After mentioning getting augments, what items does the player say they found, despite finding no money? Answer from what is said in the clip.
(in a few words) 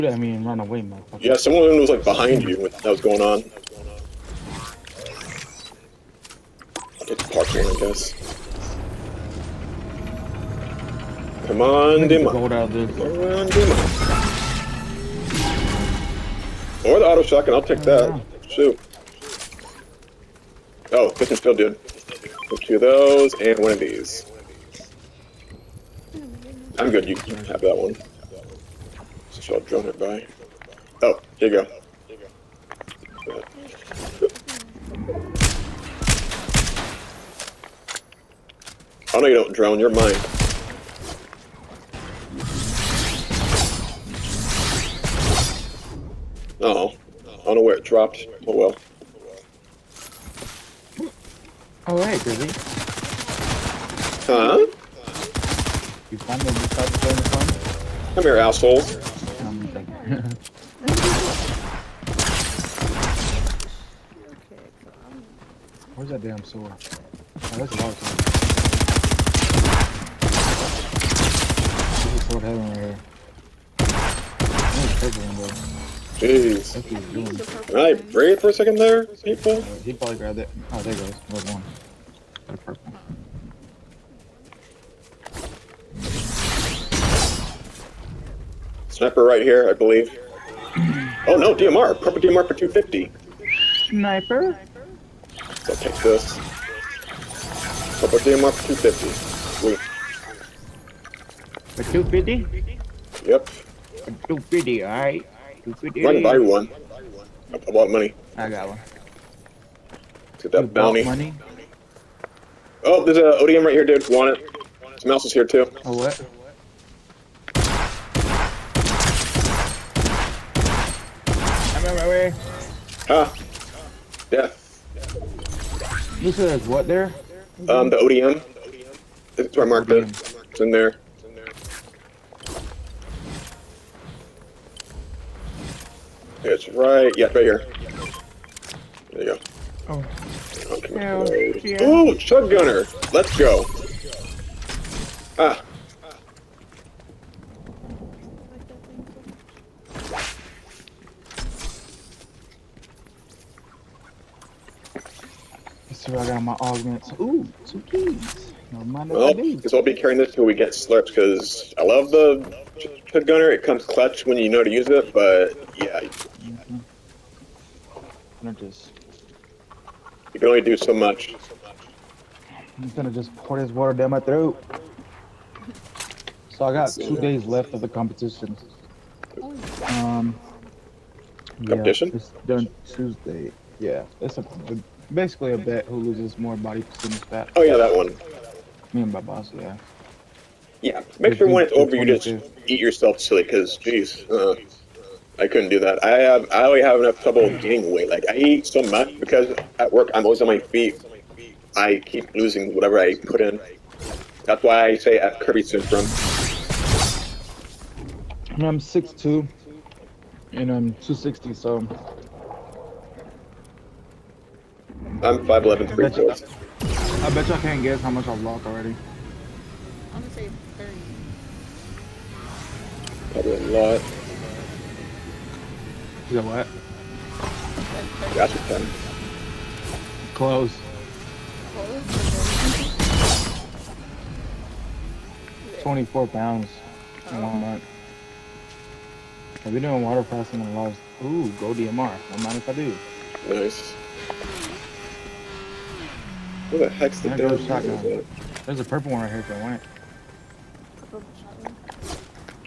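two keys.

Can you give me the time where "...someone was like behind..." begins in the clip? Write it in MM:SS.
00:01.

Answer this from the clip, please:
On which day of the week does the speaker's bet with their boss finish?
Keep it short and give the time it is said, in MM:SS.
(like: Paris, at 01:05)
Tuesday, at 03:02.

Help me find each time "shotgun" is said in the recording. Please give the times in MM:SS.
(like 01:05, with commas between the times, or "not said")
00:17, 04:07.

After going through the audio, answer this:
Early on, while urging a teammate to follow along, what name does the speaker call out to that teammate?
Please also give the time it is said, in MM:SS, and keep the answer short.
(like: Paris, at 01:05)
Dima, at 00:12.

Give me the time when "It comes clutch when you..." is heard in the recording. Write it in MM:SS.
02:43.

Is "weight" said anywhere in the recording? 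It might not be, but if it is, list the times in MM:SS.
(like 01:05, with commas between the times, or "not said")
03:17.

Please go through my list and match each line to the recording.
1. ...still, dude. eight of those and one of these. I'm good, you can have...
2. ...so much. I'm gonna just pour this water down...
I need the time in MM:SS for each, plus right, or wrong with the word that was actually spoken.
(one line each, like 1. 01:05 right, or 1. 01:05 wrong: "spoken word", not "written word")
1. 00:21 wrong: "two", not "eight"
2. 02:50 right.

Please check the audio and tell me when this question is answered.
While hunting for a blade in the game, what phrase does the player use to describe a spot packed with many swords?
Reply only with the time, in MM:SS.
01:12.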